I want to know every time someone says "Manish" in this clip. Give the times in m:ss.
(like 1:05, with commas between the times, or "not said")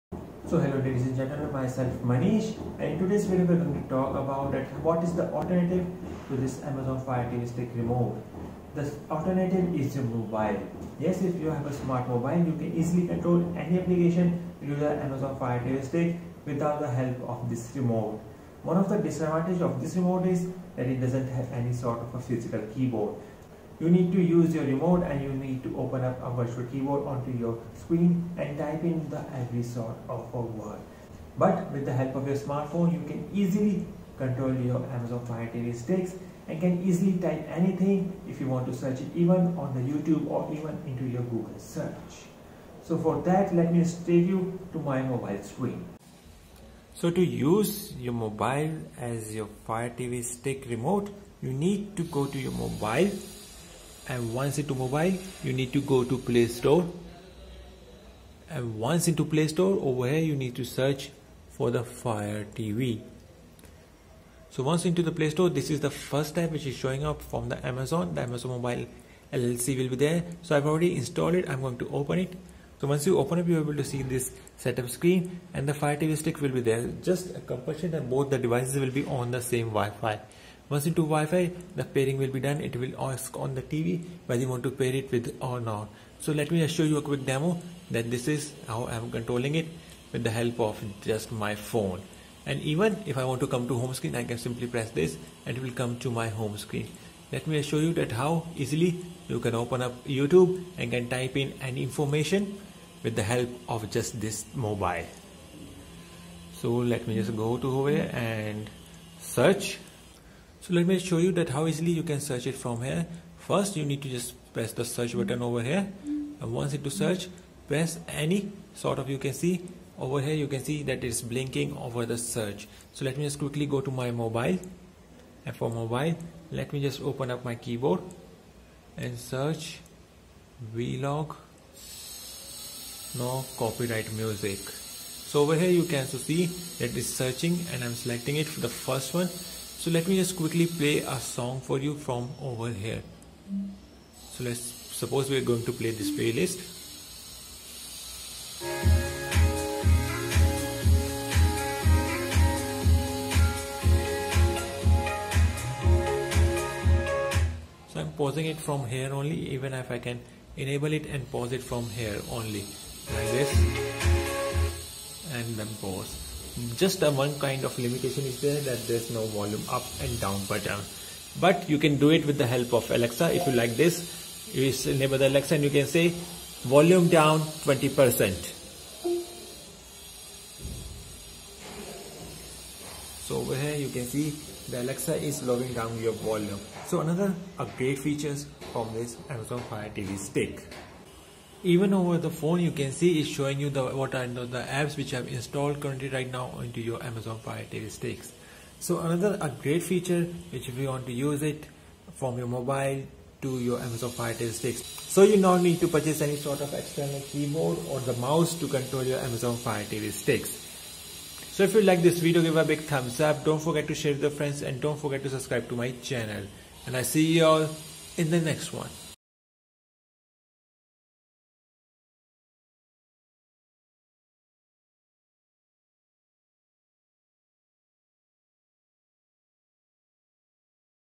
0:02.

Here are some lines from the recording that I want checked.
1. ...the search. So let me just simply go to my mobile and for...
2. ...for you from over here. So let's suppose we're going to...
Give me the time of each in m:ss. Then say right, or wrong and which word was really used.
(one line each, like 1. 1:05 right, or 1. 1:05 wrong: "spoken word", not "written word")
1. 2:02 wrong: "quickly", not "simply"
2. 2:21 right.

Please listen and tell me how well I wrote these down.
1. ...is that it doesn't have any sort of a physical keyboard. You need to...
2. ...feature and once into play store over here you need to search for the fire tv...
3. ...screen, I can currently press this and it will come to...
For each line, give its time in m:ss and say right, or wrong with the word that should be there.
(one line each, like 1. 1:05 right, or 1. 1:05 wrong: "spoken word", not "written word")
1. 0:20 right
2. 0:56 wrong: "store", not "feature"
3. 1:33 wrong: "simply", not "currently".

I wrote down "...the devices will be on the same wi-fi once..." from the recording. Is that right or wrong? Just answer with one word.
right.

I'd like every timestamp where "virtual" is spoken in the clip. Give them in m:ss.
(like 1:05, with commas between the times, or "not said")
0:26.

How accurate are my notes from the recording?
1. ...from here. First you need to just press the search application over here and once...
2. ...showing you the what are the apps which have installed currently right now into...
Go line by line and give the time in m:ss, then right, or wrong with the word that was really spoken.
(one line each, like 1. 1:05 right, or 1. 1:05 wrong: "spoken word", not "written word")
1. 1:52 wrong: "button", not "application"
2. 3:13 right.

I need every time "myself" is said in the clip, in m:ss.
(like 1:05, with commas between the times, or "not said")
0:01.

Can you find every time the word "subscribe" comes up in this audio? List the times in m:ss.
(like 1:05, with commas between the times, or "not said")
3:35.